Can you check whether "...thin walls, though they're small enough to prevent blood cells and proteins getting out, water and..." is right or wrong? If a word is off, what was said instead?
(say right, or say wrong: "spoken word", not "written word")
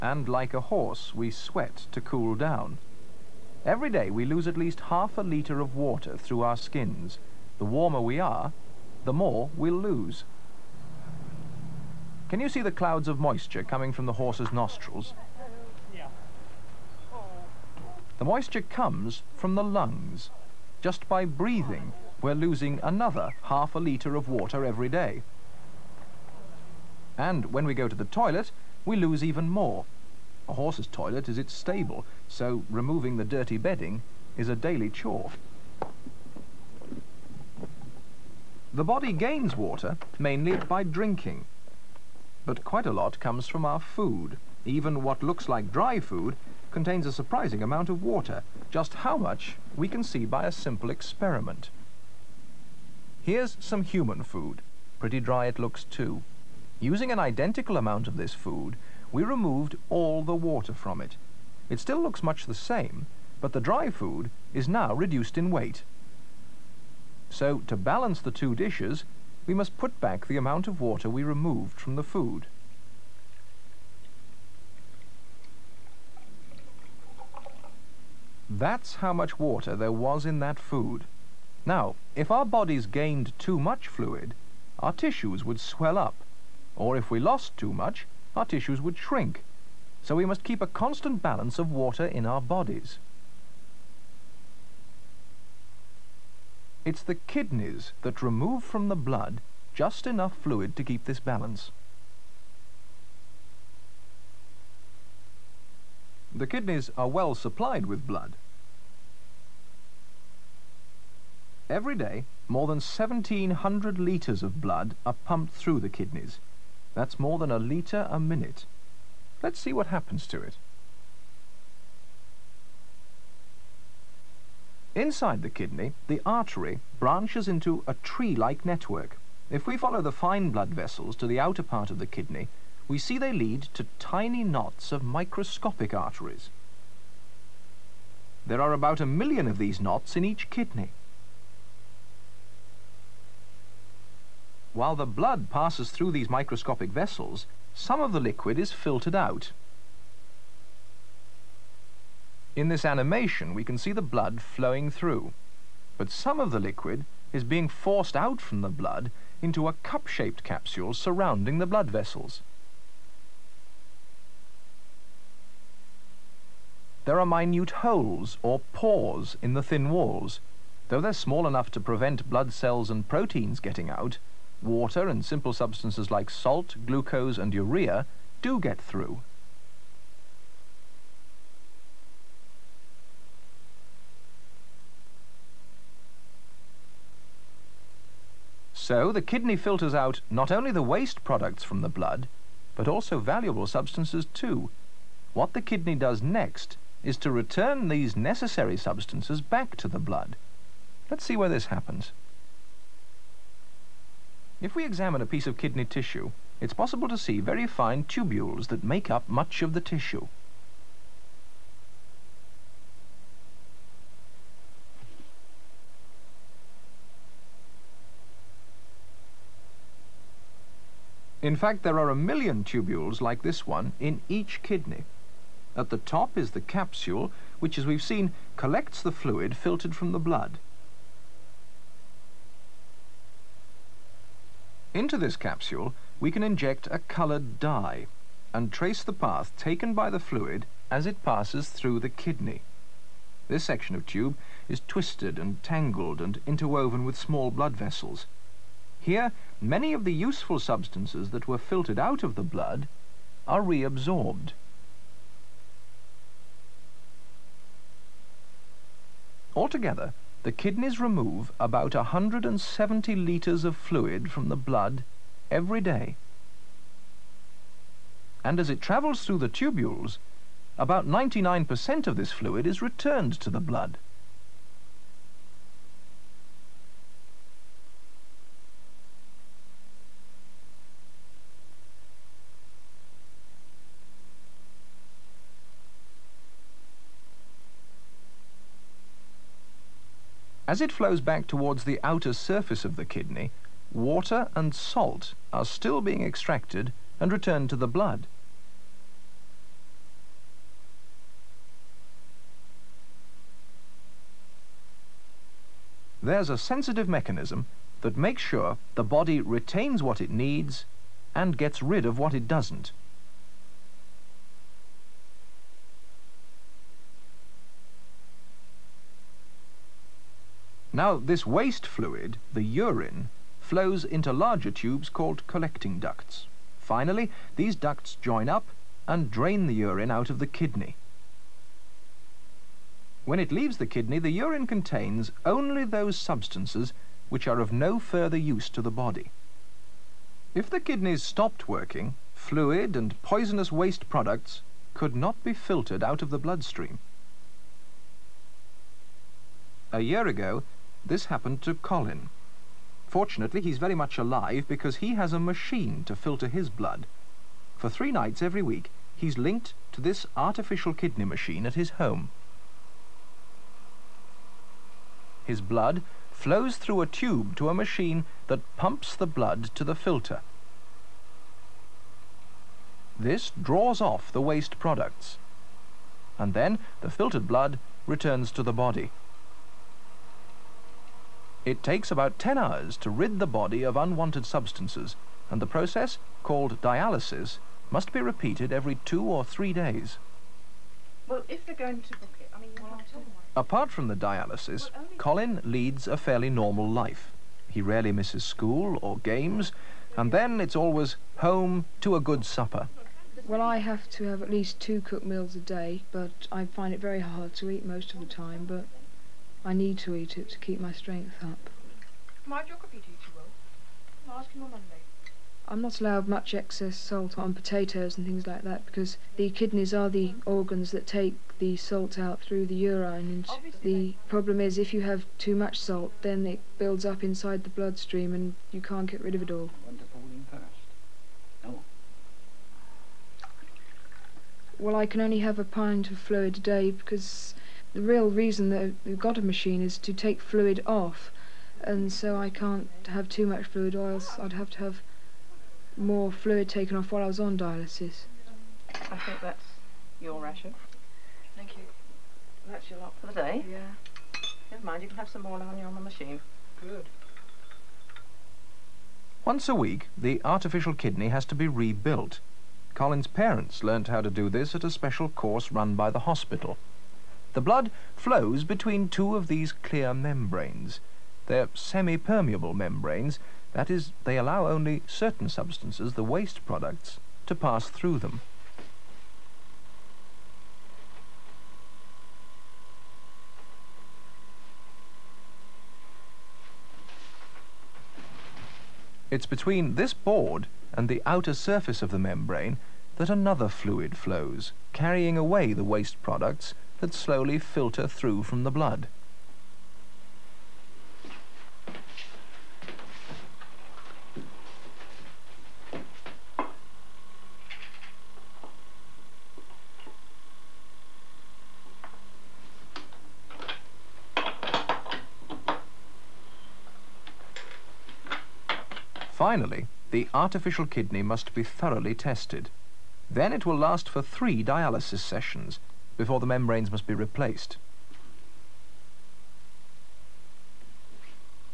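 right.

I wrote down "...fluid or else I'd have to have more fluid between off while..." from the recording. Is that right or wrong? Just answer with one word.
wrong.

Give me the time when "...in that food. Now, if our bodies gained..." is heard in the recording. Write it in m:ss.
1:20.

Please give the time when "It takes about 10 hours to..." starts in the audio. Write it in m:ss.
6:21.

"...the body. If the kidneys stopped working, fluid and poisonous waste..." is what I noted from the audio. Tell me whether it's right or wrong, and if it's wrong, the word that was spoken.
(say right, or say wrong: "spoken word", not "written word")
right.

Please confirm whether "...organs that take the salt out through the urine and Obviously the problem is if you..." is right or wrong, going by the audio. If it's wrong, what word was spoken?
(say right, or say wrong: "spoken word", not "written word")
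right.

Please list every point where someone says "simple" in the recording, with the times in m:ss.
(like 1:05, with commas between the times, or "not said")
0:50, 2:55.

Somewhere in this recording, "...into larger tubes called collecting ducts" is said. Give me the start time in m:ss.
5:24.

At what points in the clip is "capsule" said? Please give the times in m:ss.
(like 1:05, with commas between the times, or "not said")
2:40, 3:46, 3:55.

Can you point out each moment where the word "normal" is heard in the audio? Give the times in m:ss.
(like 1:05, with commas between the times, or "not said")
6:36.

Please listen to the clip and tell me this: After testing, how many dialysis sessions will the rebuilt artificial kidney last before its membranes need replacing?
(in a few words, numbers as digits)
3.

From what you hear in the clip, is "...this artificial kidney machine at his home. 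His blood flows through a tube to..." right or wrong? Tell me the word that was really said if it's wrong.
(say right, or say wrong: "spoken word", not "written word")
right.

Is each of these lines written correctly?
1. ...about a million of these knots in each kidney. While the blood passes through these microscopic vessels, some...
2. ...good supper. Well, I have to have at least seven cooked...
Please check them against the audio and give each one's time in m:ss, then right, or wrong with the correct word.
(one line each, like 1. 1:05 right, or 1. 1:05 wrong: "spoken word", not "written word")
1. 2:18 right
2. 6:42 wrong: "two", not "seven".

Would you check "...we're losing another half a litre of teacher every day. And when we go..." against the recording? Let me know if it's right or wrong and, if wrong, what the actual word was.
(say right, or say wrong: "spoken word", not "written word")
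wrong: "water", not "teacher".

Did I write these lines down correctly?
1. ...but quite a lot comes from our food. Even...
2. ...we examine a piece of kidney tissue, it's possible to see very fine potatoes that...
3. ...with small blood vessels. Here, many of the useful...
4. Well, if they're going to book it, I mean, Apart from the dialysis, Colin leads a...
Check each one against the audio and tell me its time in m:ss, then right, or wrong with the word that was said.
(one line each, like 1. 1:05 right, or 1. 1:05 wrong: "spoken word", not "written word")
1. 0:42 right
2. 3:24 wrong: "tubules", not "potatoes"
3. 4:07 right
4. 6:31 right.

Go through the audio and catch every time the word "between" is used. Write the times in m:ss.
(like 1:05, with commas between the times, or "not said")
7:48, 8:09.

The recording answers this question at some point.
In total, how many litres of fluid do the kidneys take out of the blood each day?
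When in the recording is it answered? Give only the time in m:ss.
4:21.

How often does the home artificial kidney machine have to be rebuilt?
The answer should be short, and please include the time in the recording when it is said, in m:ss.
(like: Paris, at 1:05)
Once a week, at 7:39.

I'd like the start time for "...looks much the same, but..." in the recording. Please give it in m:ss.
1:02.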